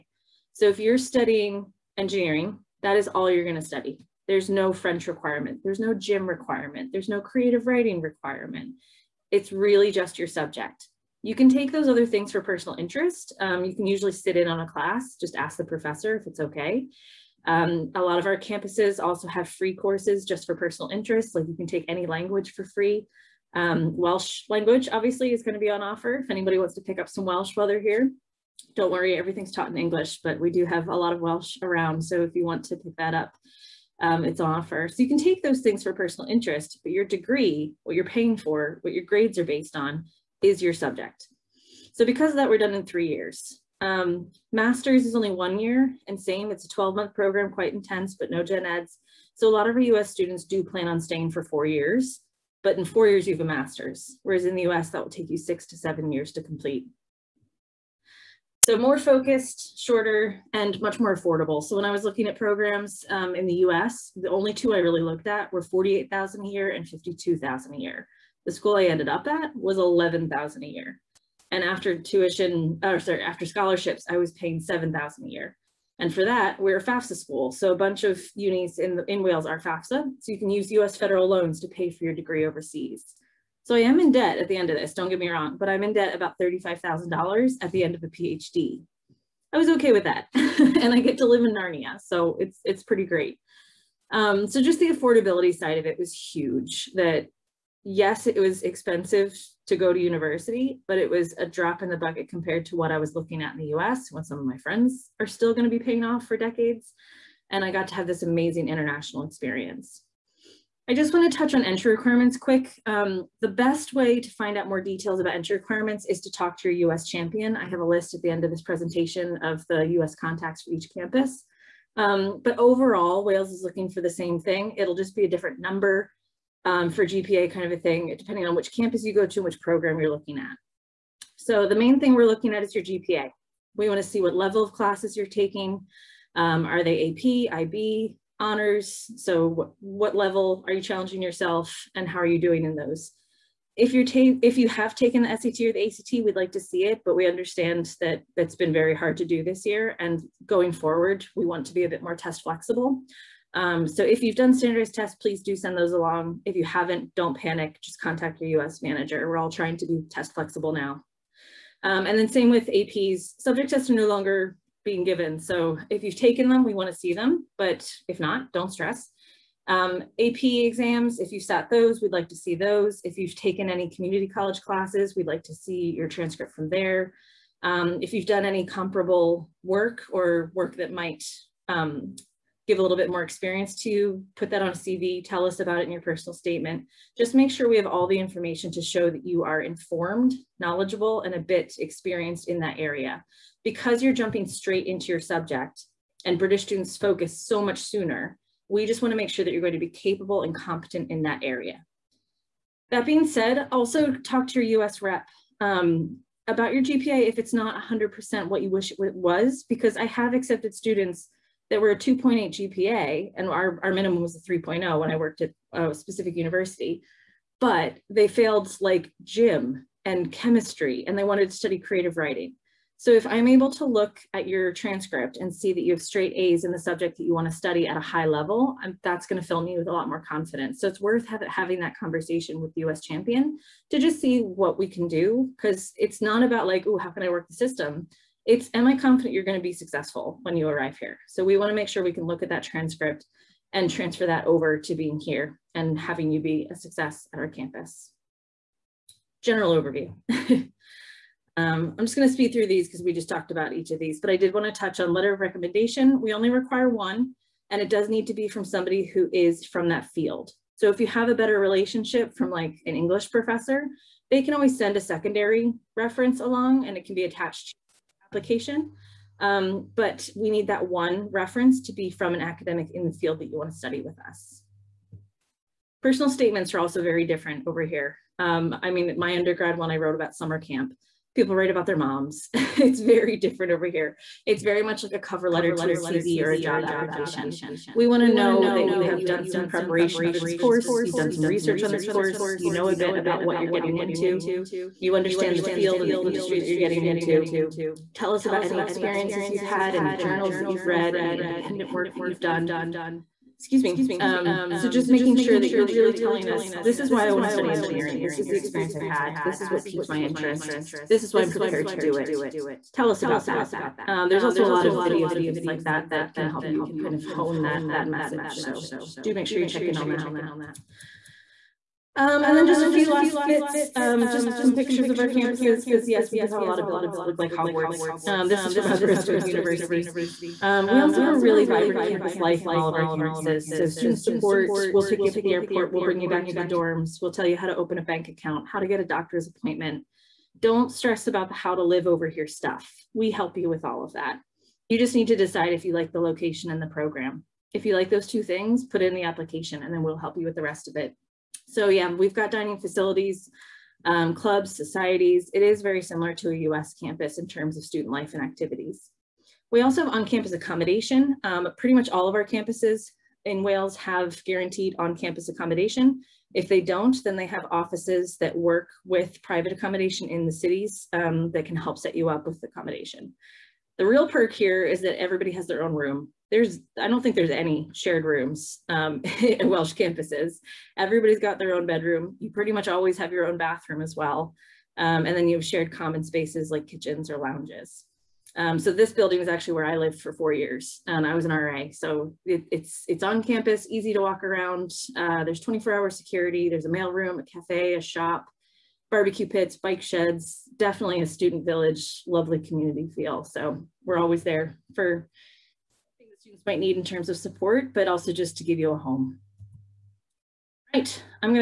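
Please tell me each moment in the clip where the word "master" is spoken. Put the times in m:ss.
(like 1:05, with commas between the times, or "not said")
0:44, 0:53.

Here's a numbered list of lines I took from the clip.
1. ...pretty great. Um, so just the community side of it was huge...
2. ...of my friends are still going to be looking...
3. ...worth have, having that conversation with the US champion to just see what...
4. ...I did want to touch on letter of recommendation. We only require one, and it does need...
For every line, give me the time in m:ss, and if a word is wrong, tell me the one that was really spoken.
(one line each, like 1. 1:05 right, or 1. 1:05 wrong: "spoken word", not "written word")
1. 1:32 wrong: "affordability", not "community"
2. 1:44 wrong: "paying", not "looking"
3. 3:50 right
4. 4:14 right.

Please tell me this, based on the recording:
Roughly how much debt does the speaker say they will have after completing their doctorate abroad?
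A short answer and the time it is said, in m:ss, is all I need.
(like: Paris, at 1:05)
$35,000, at 1:26.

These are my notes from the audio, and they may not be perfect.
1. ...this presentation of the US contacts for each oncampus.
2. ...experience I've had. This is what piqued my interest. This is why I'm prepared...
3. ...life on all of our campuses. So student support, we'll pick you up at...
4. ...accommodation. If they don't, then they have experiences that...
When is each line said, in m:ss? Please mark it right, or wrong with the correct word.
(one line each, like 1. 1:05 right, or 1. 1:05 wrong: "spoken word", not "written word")
1. 1:58 wrong: "campus", not "oncampus"
2. 5:08 right
3. 5:32 right
4. 6:05 wrong: "offices", not "experiences".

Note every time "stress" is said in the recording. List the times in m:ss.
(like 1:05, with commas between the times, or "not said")
2:48, 5:40.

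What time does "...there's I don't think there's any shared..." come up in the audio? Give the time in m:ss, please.
6:16.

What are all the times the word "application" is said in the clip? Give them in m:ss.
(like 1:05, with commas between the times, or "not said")
4:28, 4:46, 5:49.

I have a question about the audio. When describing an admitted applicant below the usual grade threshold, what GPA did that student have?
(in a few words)
2.8.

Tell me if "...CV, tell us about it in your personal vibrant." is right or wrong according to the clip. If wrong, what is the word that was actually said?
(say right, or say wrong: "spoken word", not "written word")
wrong: "statement", not "vibrant".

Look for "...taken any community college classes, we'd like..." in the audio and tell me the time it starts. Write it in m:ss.
2:53.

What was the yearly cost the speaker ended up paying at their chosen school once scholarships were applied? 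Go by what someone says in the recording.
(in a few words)
$7,000.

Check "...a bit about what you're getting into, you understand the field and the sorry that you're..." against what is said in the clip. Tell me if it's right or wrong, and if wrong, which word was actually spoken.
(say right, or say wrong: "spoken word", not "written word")
wrong: "industry", not "sorry".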